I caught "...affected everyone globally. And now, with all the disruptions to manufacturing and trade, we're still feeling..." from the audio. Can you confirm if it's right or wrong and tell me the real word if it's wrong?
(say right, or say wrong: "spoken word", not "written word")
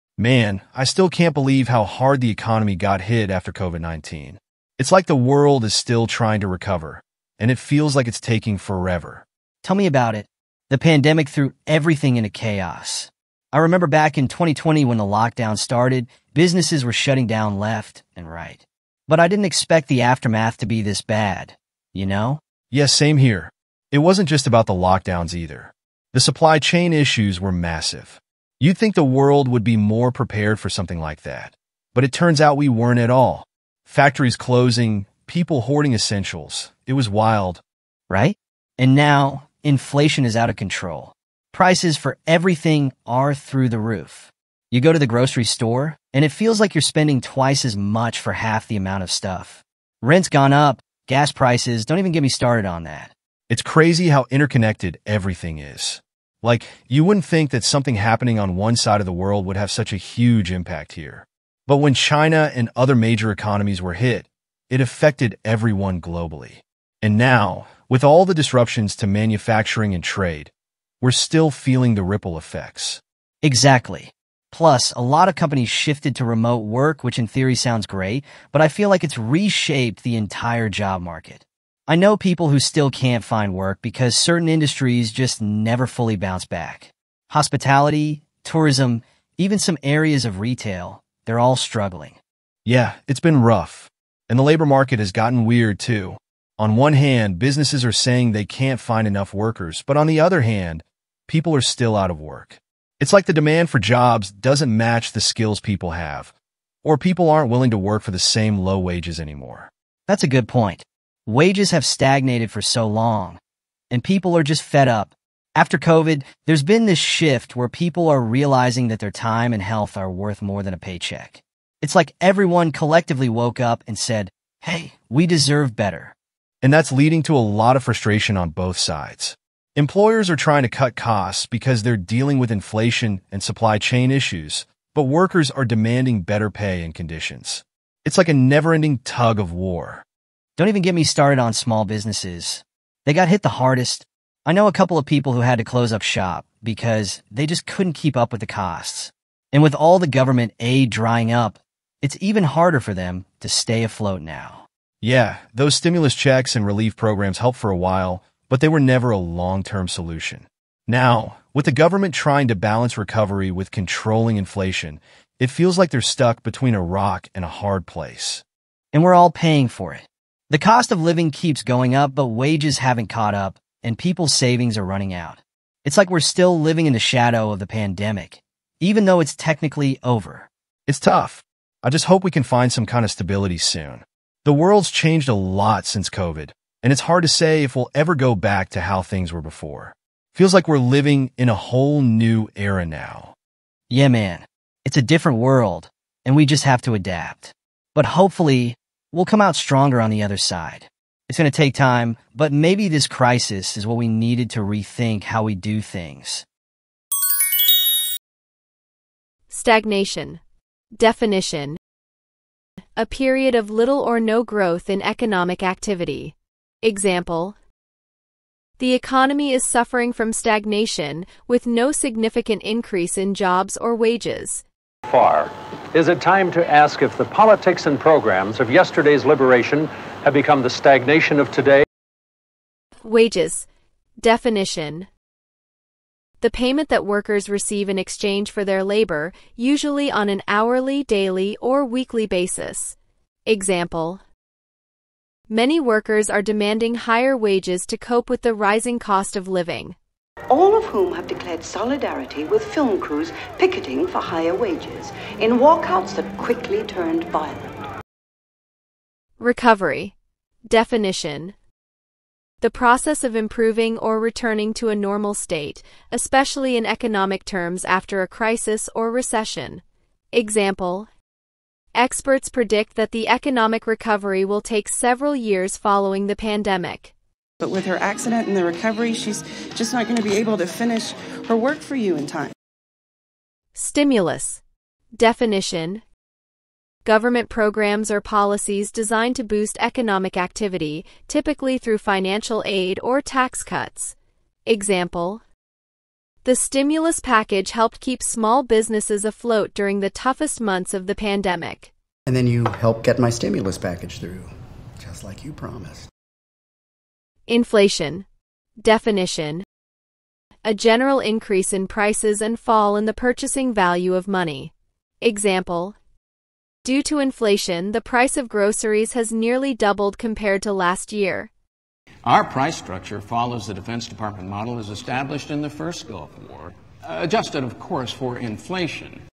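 right.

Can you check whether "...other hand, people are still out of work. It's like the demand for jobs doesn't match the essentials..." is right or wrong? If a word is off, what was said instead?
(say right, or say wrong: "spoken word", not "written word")
wrong: "skills", not "essentials".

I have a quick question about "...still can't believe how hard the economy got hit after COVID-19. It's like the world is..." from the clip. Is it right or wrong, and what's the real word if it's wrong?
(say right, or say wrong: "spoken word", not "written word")
right.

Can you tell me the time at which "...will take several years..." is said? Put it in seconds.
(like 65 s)
274 s.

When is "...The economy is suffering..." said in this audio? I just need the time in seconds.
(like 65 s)
218 s.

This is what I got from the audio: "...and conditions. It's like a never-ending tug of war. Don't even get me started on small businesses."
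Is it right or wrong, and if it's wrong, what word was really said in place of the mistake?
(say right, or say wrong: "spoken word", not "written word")
right.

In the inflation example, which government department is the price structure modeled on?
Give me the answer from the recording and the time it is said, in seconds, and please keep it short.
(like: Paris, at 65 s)
Defense Department, at 323 s.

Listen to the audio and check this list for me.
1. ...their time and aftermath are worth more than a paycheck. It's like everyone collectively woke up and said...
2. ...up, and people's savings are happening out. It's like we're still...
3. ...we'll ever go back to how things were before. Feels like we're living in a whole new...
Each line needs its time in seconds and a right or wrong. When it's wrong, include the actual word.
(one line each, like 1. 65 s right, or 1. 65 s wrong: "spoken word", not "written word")
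1. 118 s wrong: "health", not "aftermath"
2. 173 s wrong: "running", not "happening"
3. 187 s right.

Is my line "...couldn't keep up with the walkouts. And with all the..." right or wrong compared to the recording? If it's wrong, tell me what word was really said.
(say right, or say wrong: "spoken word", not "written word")
wrong: "costs", not "walkouts".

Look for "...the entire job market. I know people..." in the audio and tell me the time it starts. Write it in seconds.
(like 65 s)
80 s.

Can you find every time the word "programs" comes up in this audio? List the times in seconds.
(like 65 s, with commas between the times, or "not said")
156 s, 227 s, 287 s.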